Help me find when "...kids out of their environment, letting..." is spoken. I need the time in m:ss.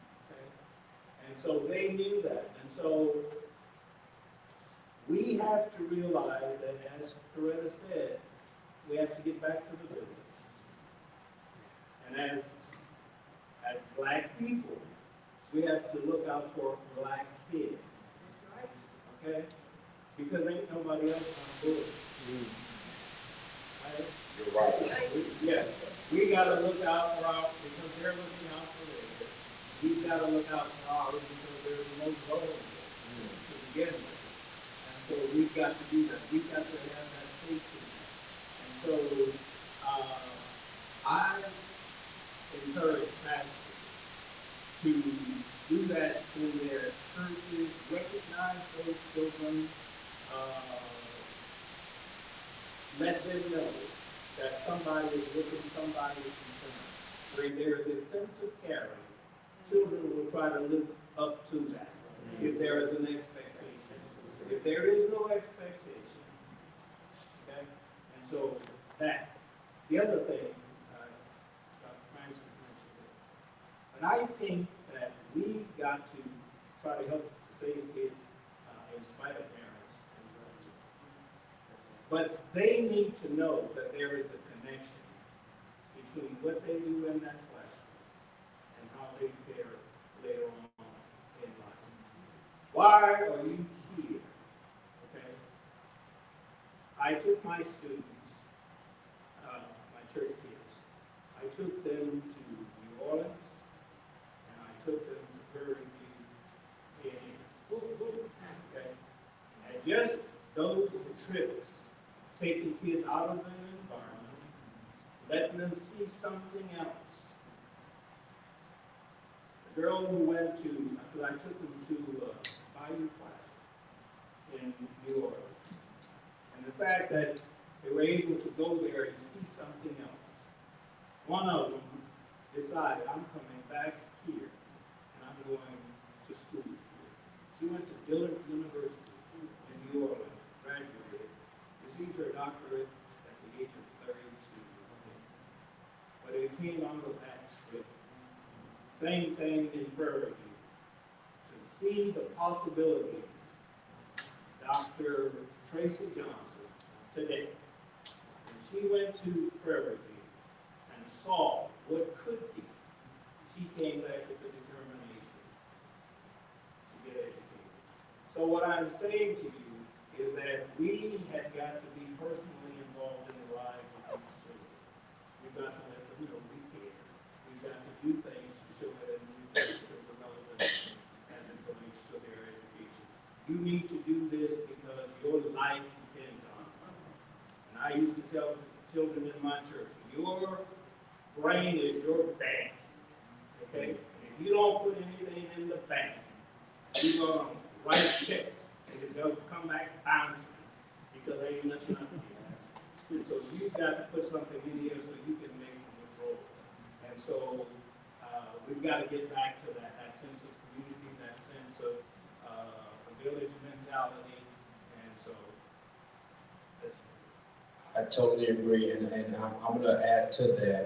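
1:52.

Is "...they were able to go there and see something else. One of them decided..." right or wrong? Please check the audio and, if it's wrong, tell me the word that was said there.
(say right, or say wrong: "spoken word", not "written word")
right.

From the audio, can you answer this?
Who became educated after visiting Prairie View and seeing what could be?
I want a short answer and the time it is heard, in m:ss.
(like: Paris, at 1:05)
Dr. Tracy Johnson, at 2:34.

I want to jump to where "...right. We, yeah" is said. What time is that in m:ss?
0:24.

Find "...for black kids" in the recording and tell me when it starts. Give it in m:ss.
0:16.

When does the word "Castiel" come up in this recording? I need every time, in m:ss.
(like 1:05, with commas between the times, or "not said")
not said.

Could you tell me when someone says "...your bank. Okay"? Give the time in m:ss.
3:12.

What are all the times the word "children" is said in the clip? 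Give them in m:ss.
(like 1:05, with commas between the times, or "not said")
0:49, 0:59, 2:54, 3:08.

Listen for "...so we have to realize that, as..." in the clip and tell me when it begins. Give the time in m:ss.
0:02.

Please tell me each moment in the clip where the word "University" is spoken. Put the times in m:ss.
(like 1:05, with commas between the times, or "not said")
2:18.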